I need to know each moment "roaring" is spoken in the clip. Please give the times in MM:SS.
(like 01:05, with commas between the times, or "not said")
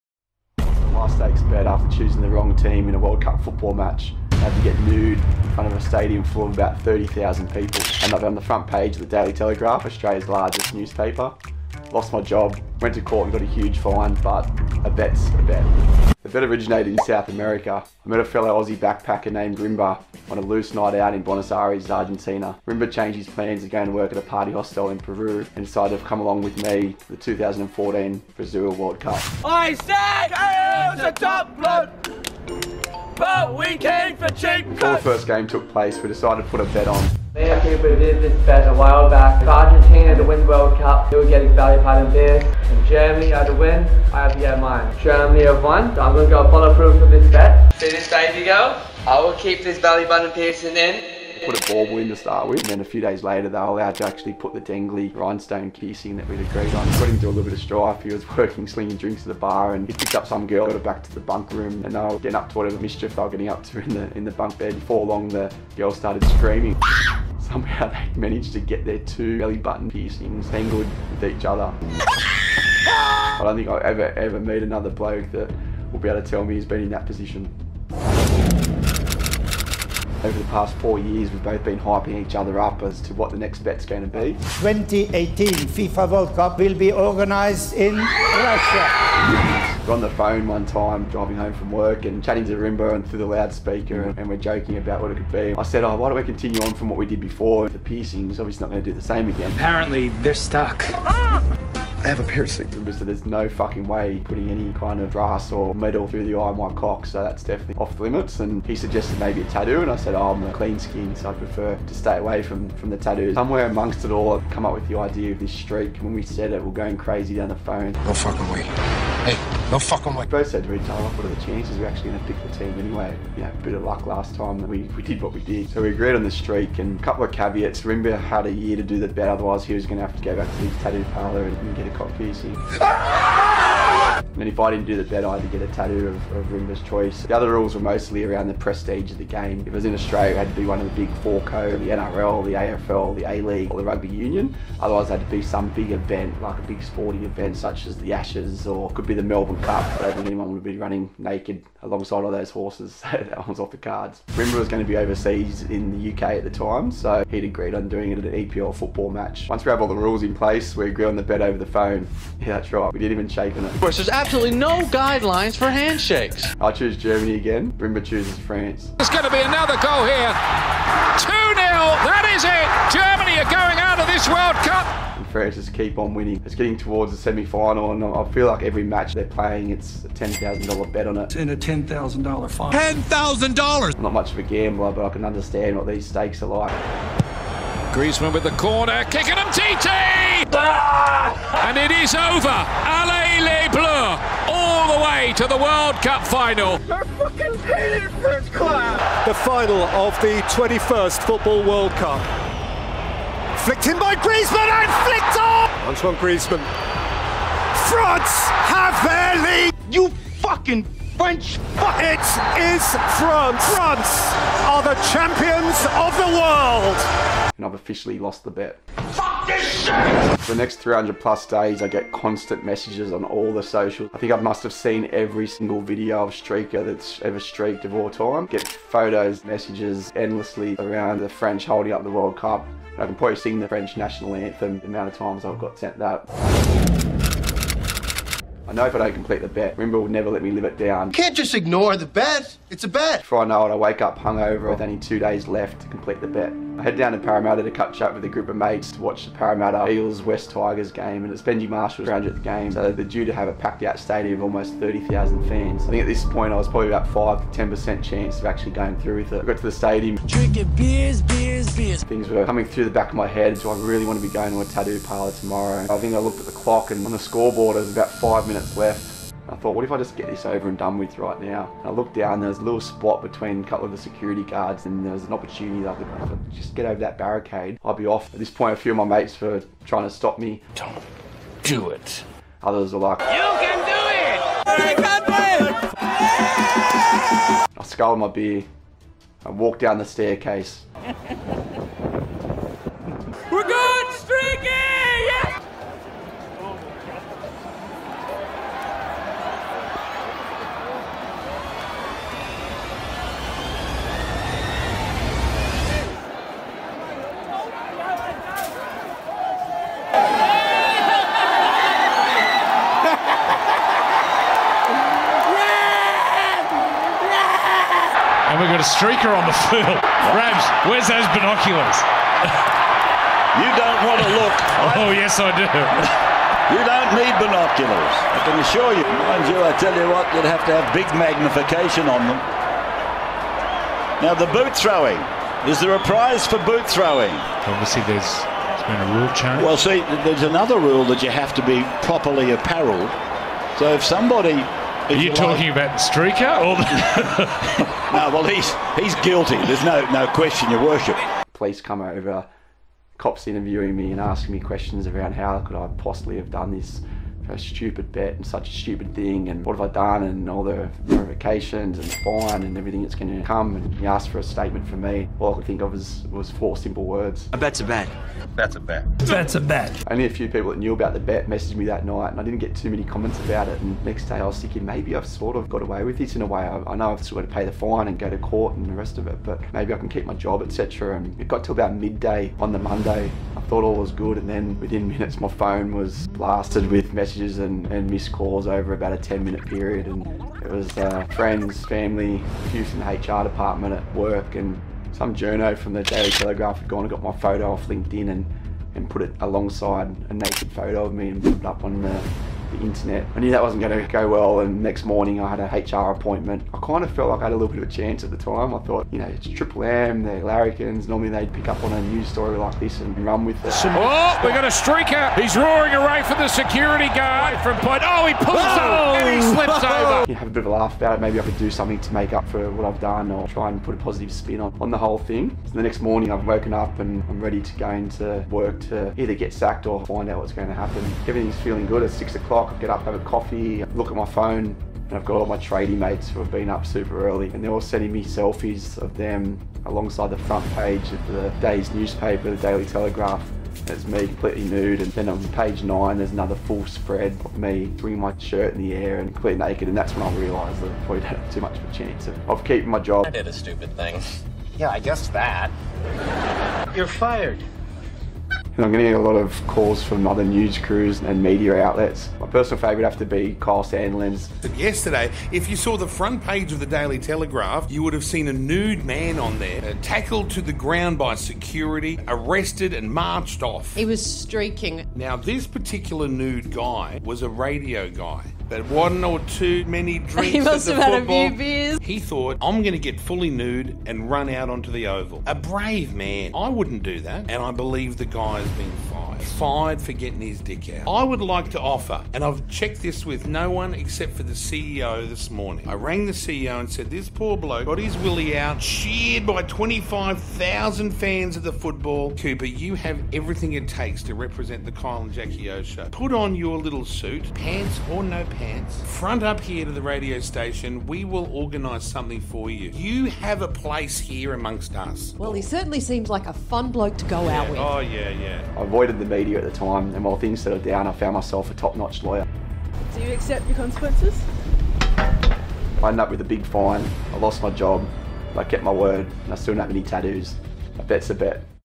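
06:55.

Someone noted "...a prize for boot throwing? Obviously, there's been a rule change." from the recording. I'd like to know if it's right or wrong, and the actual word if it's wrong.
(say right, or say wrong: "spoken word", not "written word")
right.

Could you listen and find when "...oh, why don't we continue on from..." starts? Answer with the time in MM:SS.
01:35.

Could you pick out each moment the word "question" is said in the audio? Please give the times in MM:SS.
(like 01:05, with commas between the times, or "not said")
05:50, 05:54.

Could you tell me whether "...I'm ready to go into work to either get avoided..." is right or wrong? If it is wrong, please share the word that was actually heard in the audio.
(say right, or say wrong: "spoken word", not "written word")
wrong: "sacked", not "avoided".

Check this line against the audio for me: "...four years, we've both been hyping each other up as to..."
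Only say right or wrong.
right.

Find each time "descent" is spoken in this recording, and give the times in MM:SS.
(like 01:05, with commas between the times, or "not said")
not said.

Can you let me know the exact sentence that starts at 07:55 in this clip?
Now, this particular nude guy was a radio guy.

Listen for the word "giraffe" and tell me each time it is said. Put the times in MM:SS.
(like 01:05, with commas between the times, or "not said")
not said.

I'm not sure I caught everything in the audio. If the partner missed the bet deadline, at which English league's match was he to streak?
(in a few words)
EPL.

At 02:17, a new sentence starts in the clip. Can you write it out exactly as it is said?
The other rules were mostly around the prestige of the game.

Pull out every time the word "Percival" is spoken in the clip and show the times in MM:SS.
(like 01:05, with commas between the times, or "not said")
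not said.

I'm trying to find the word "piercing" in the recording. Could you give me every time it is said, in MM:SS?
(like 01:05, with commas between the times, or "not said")
00:50, 00:55, 01:09, 01:37.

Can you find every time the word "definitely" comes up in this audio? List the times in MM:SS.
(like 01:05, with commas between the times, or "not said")
01:47.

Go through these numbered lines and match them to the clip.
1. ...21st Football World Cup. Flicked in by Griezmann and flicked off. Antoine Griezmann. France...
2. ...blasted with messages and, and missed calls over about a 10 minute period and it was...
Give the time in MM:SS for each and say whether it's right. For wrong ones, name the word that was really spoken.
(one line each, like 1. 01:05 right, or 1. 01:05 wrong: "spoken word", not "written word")
1. 03:20 right
2. 06:26 right.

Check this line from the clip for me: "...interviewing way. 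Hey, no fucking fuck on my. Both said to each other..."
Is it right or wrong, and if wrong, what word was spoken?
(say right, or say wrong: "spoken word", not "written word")
wrong: "fucking", not "interviewing".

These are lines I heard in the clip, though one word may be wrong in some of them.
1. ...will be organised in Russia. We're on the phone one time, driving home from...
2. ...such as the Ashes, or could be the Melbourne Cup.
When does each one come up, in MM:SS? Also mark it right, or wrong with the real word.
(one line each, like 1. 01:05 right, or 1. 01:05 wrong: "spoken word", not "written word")
1. 01:26 right
2. 02:27 right.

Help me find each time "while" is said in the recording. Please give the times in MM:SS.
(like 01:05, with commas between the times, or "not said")
00:38, 08:40.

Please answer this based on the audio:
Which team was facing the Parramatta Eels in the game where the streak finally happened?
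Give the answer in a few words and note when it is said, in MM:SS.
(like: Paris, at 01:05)
Wests Tigers, at 04:10.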